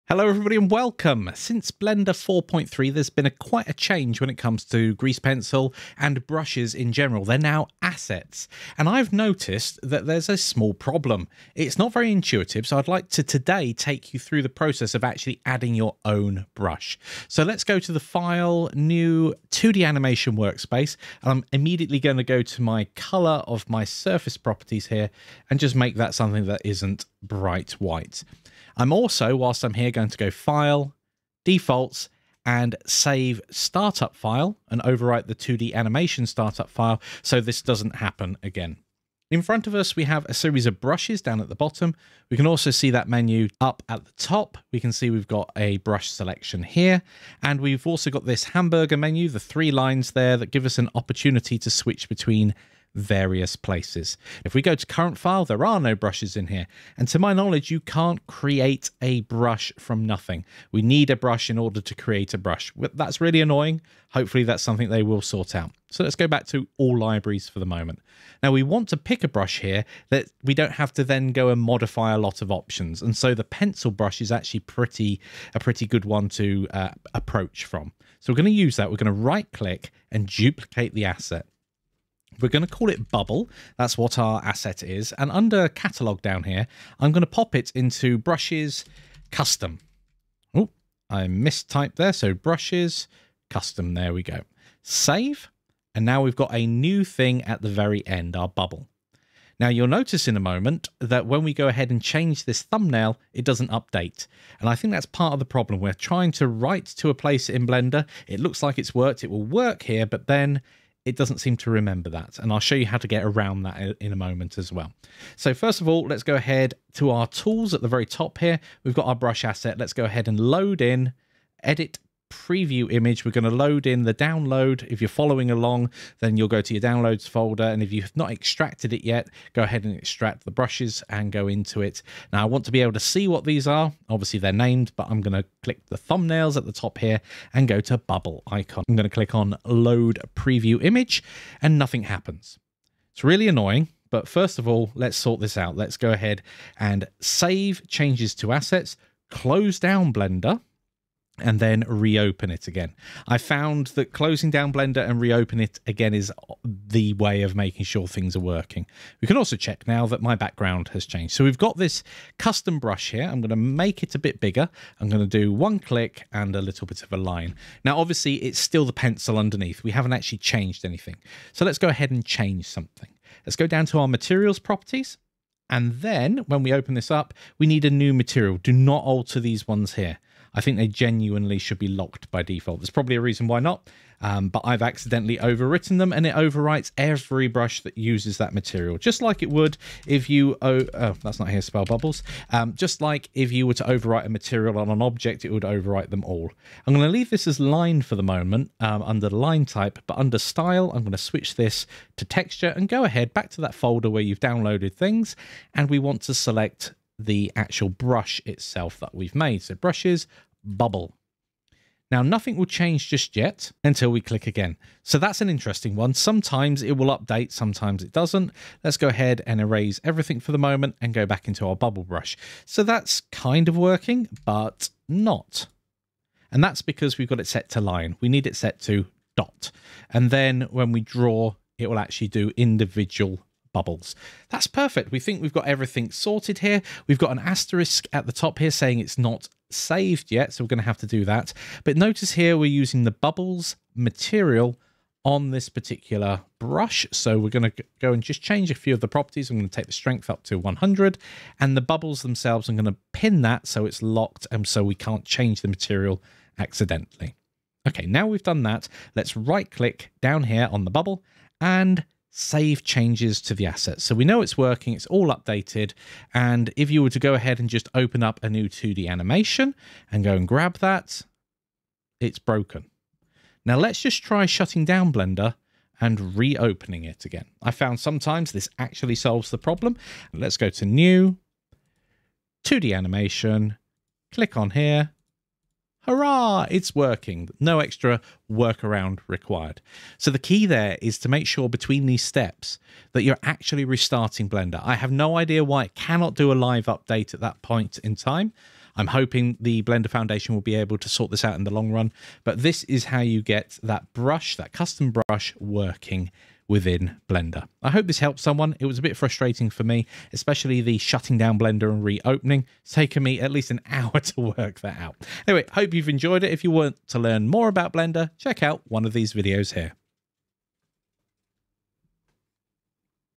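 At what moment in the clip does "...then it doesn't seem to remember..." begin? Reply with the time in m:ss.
1:50.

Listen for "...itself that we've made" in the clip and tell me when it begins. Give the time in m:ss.
3:28.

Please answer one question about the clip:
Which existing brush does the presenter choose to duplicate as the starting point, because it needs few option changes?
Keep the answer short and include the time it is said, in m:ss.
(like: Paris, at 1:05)
pencil brush, at 1:13.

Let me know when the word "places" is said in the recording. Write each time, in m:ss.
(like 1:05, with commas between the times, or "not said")
0:53, 1:47.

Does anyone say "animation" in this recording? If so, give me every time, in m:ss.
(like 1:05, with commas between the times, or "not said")
0:19, 0:35, 4:29, 4:42.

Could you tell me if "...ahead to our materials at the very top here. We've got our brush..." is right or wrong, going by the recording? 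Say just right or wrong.
wrong.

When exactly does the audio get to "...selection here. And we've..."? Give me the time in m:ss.
0:46.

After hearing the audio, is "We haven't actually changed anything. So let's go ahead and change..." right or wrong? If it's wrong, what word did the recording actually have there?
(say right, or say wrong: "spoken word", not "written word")
right.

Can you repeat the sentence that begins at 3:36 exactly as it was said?
Sometimes it will update, sometimes it doesn't.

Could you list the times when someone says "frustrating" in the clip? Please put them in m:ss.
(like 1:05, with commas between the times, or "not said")
5:09.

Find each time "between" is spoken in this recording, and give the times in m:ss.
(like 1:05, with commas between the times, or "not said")
0:52, 4:51.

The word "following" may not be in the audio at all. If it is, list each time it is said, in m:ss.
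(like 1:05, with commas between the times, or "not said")
2:05.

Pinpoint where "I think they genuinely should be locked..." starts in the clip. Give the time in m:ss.
3:00.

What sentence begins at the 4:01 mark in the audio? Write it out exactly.
But notice here we're using the bubbles material on this particular brush.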